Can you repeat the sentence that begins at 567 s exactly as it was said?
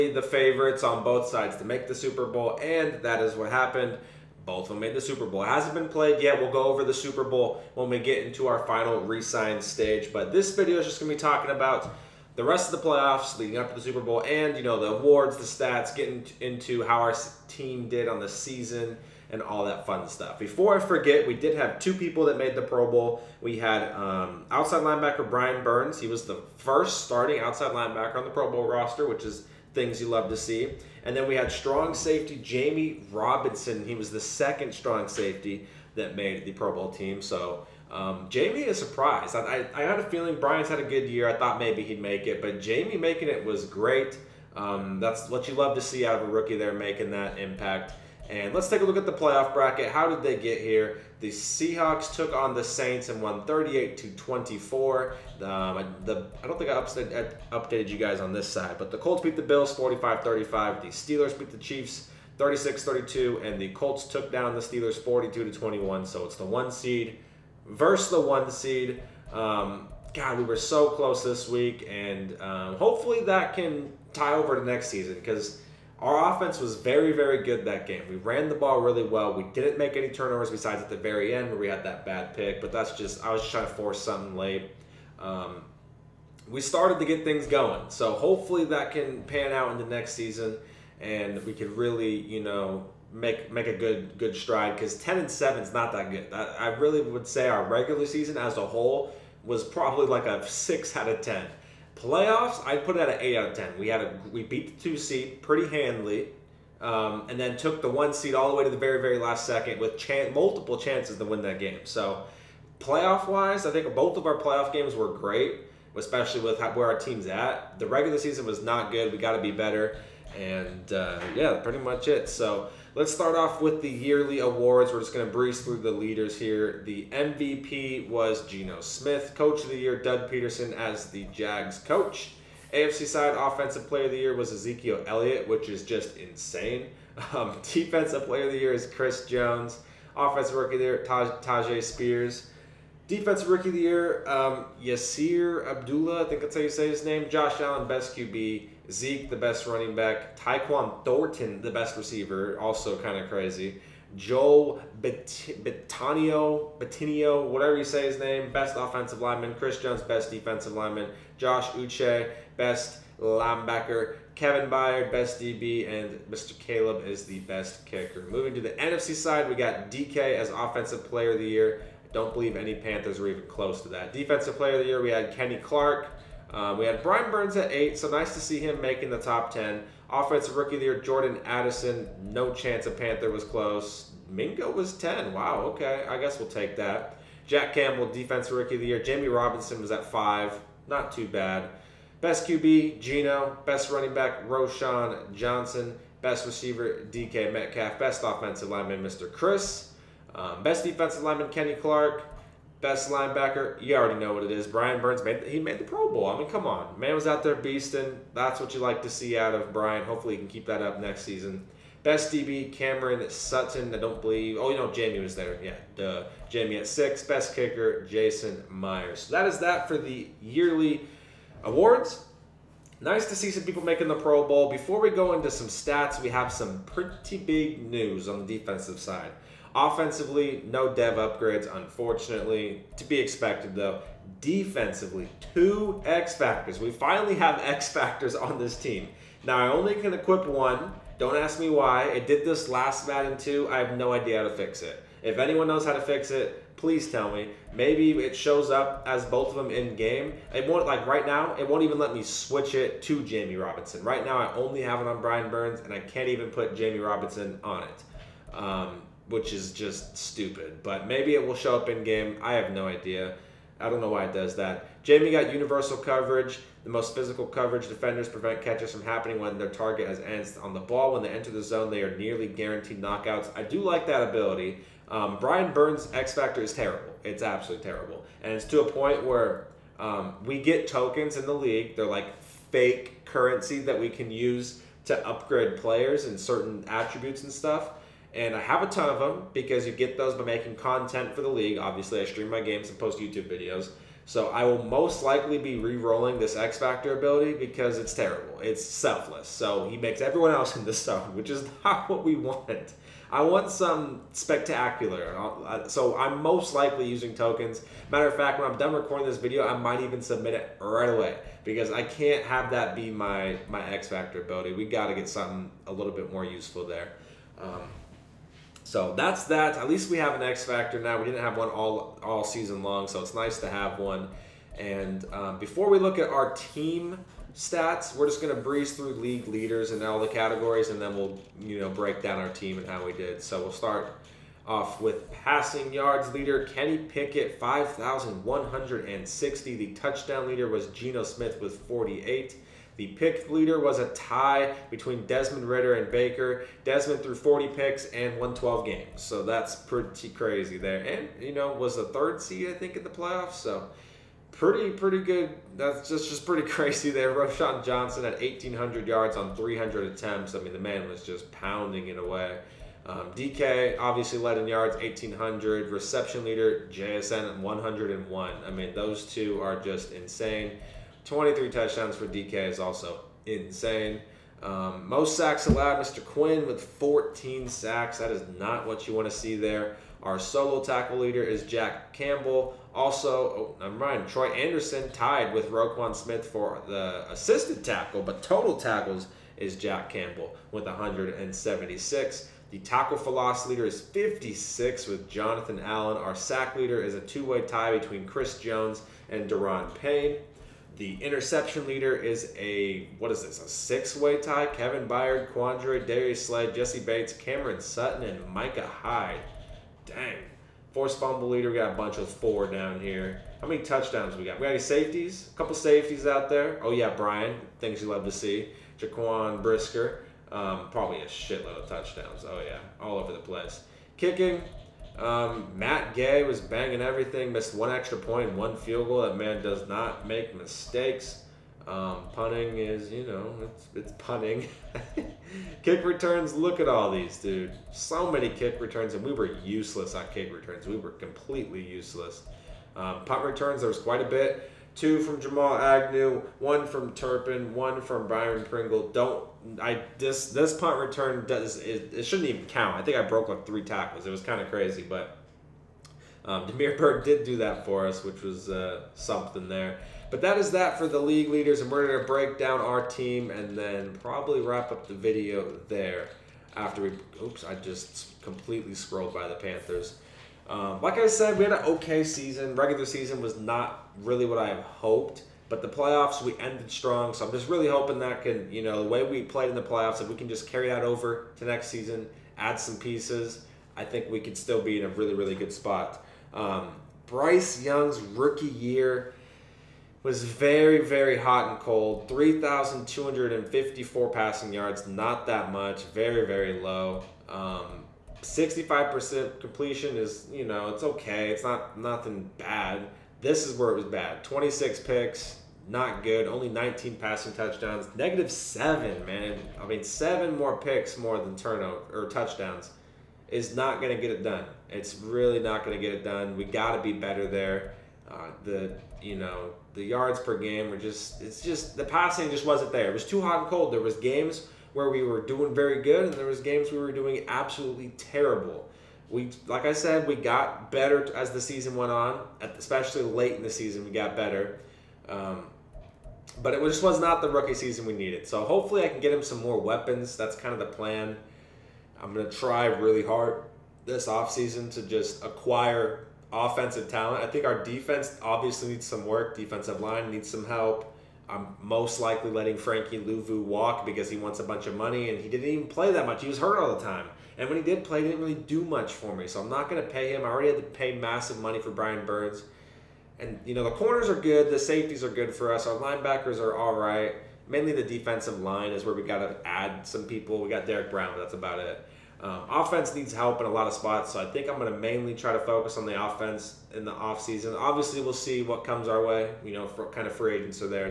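Mainly the defensive line is where we got to add some people.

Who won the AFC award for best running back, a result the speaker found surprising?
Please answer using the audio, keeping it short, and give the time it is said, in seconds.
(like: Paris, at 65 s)
Ezekiel Elliott, at 134 s.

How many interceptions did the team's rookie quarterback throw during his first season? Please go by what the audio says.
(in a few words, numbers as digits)
26.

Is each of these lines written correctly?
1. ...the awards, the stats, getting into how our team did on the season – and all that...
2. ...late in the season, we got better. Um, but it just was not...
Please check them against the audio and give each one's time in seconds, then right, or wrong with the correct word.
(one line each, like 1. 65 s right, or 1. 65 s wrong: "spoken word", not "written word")
1. 14 s right
2. 533 s right.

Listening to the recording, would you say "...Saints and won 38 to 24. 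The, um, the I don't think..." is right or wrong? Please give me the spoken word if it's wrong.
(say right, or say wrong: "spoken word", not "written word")
right.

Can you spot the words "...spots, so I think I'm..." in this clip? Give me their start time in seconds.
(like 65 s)
573 s.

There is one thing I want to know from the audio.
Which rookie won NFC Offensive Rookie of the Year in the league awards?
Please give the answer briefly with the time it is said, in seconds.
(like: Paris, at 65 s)
Jordan Addison, at 181 s.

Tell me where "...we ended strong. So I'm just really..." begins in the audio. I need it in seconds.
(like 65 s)
476 s.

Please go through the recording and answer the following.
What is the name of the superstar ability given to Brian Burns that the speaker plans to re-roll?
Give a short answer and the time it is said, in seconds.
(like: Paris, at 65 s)
selfless, at 298 s.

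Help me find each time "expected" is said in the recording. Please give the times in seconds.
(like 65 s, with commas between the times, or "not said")
233 s.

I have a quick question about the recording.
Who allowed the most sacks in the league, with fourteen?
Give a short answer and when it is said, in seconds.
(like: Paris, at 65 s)
Quinn, at 376 s.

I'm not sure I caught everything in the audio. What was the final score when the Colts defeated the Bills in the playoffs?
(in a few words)
45-35.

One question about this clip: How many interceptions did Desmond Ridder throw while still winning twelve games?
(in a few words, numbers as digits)
40.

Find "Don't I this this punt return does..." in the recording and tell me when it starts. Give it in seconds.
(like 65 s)
449 s.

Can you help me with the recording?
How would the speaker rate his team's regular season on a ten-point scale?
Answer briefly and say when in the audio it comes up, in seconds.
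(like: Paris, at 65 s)
6 out of 10, at 100 s.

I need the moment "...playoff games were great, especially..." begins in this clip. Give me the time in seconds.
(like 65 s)
114 s.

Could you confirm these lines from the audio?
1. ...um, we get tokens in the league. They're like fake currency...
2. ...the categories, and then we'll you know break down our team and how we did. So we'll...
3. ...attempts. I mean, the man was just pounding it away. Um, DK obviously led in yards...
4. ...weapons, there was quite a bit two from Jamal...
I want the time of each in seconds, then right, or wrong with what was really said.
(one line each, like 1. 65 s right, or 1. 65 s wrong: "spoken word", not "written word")
1. 279 s right
2. 330 s right
3. 360 s right
4. 443 s wrong: "returns", not "weapons".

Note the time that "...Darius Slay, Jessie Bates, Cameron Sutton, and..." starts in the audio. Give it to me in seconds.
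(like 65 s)
406 s.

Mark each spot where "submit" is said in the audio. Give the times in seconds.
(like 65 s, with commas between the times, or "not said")
310 s.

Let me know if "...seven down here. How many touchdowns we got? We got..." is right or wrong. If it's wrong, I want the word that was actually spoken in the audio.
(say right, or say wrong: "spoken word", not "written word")
wrong: "four", not "seven".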